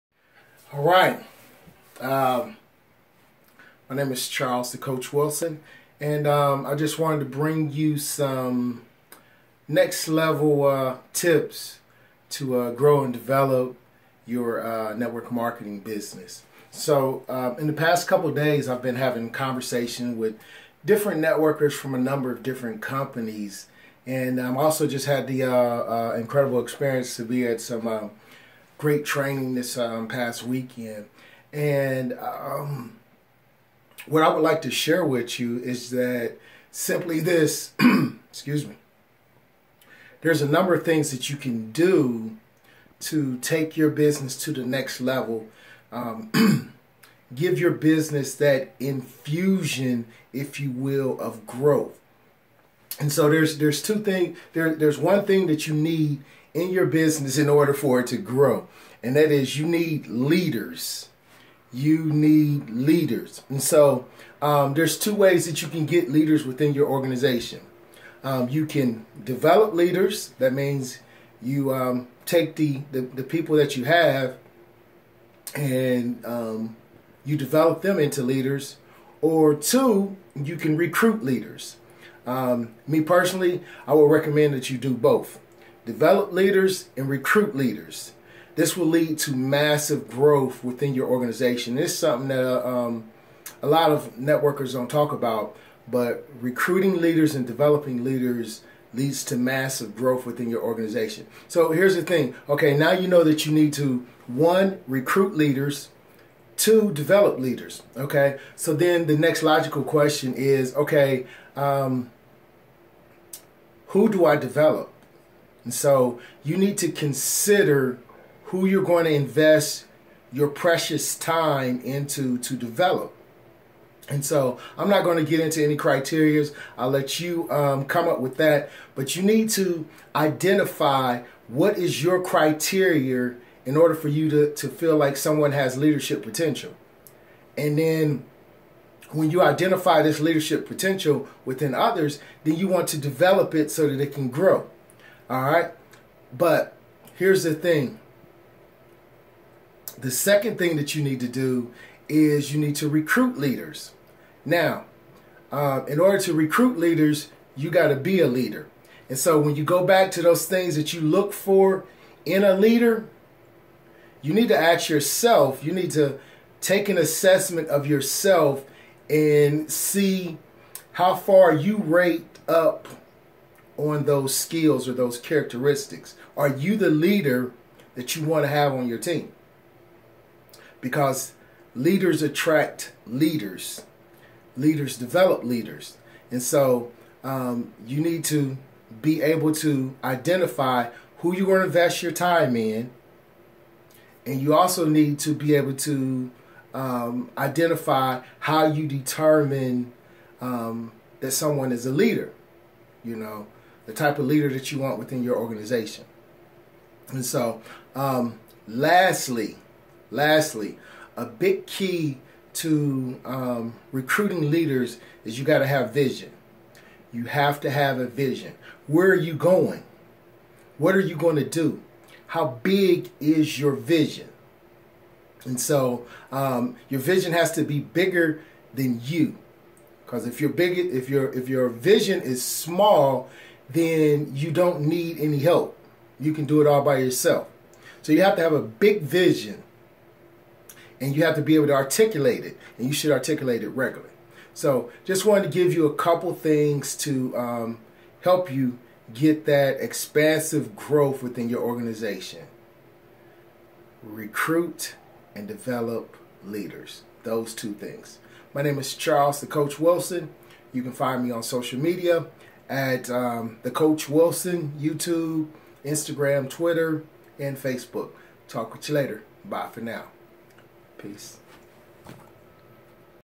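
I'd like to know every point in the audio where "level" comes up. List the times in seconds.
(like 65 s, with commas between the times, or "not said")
10 s, 44 s.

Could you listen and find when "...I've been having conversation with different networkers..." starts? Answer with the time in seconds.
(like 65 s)
18 s.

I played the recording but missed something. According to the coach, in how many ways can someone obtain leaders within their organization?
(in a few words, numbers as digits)
2.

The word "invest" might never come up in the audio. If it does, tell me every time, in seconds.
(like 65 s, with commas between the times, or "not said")
119 s, 191 s.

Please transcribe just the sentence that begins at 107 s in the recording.
Okay, so then the next logical question is okay, um, who do I develop?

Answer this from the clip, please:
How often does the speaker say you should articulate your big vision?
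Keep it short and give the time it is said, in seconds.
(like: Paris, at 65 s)
regularly, at 243 s.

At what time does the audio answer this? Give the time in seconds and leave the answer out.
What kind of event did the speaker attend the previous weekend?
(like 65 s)
29 s.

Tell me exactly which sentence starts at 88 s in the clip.
This will lead to massive growth within your organization.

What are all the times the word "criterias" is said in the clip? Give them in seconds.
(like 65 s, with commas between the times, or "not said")
125 s, 132 s.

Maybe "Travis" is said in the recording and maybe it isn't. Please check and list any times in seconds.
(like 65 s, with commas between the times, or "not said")
not said.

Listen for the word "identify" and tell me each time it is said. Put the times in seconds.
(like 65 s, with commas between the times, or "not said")
130 s, 139 s, 190 s, 197 s.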